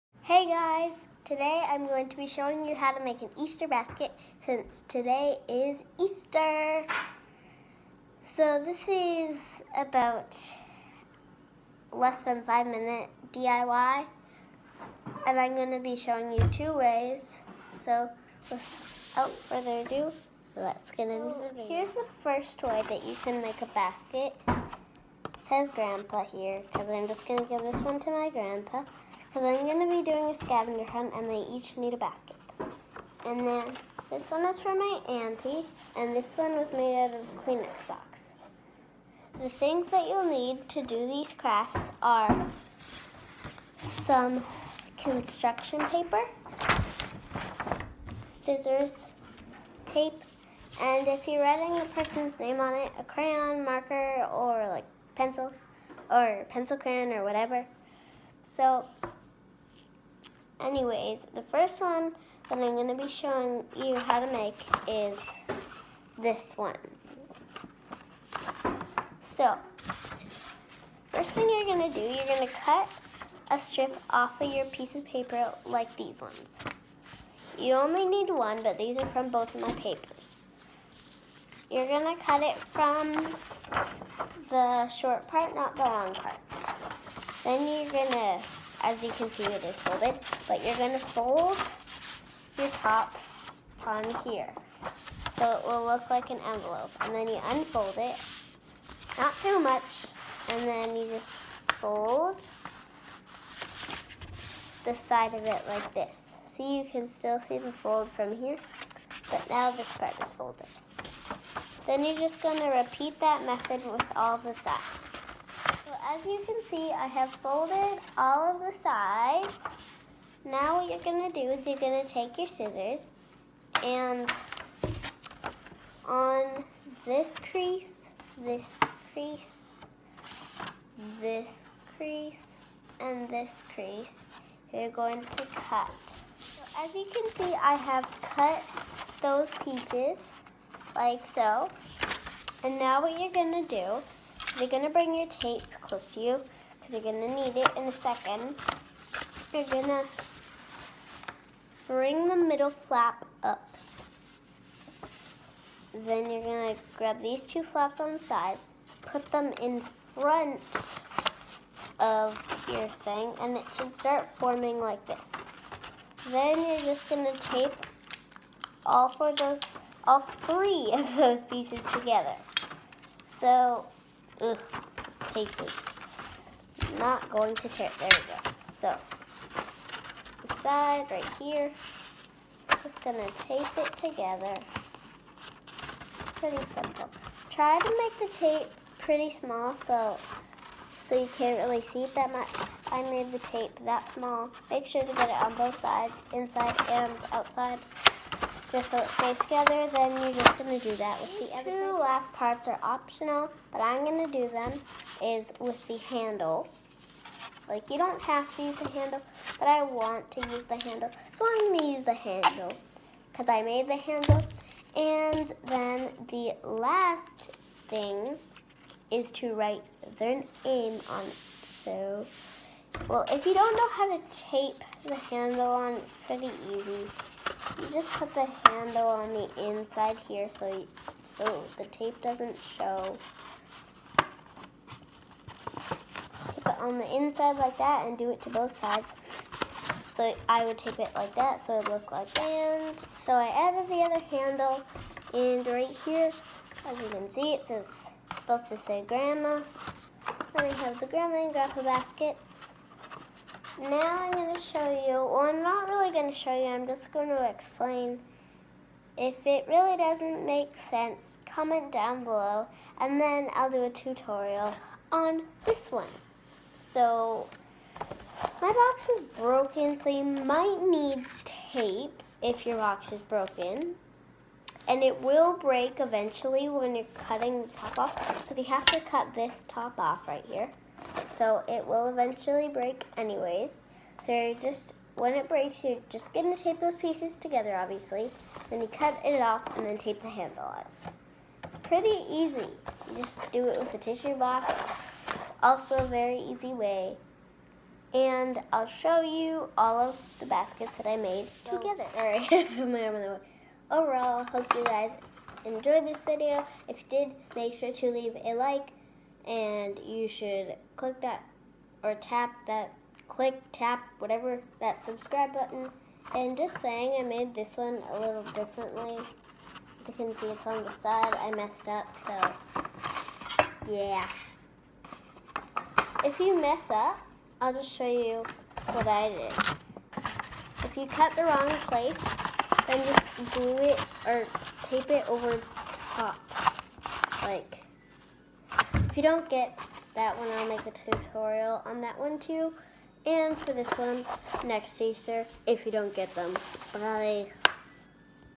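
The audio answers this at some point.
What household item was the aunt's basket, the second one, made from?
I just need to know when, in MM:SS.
00:37.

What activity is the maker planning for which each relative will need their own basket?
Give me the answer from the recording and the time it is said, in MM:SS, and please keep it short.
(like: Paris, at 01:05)
scavenger hunt, at 00:30.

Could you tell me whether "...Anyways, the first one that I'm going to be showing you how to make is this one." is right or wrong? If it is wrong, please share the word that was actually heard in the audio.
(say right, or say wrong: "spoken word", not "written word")
right.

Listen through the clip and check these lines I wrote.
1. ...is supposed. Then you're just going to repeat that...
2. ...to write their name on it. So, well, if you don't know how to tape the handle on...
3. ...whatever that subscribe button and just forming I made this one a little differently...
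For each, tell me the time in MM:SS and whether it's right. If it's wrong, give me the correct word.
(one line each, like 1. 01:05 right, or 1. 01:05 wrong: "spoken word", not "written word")
1. 01:50 wrong: "folded", not "supposed"
2. 03:39 right
3. 05:14 wrong: "saying", not "forming".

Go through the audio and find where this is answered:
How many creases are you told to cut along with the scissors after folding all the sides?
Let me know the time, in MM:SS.
02:07.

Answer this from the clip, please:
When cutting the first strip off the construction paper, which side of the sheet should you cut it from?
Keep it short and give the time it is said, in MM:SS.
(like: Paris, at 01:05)
the short part, at 01:24.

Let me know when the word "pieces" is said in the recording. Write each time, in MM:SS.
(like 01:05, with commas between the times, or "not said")
01:14, 02:19, 02:51, 04:46.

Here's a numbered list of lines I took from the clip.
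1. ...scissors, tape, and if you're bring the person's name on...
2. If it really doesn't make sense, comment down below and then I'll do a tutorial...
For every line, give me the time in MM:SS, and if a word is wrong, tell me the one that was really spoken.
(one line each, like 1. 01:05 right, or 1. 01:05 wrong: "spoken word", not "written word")
1. 00:48 wrong: "writing", not "bring"
2. 04:19 right.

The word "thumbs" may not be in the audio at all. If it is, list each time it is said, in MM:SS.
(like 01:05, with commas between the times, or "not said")
not said.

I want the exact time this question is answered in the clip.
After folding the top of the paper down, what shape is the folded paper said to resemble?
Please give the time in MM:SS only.
01:36.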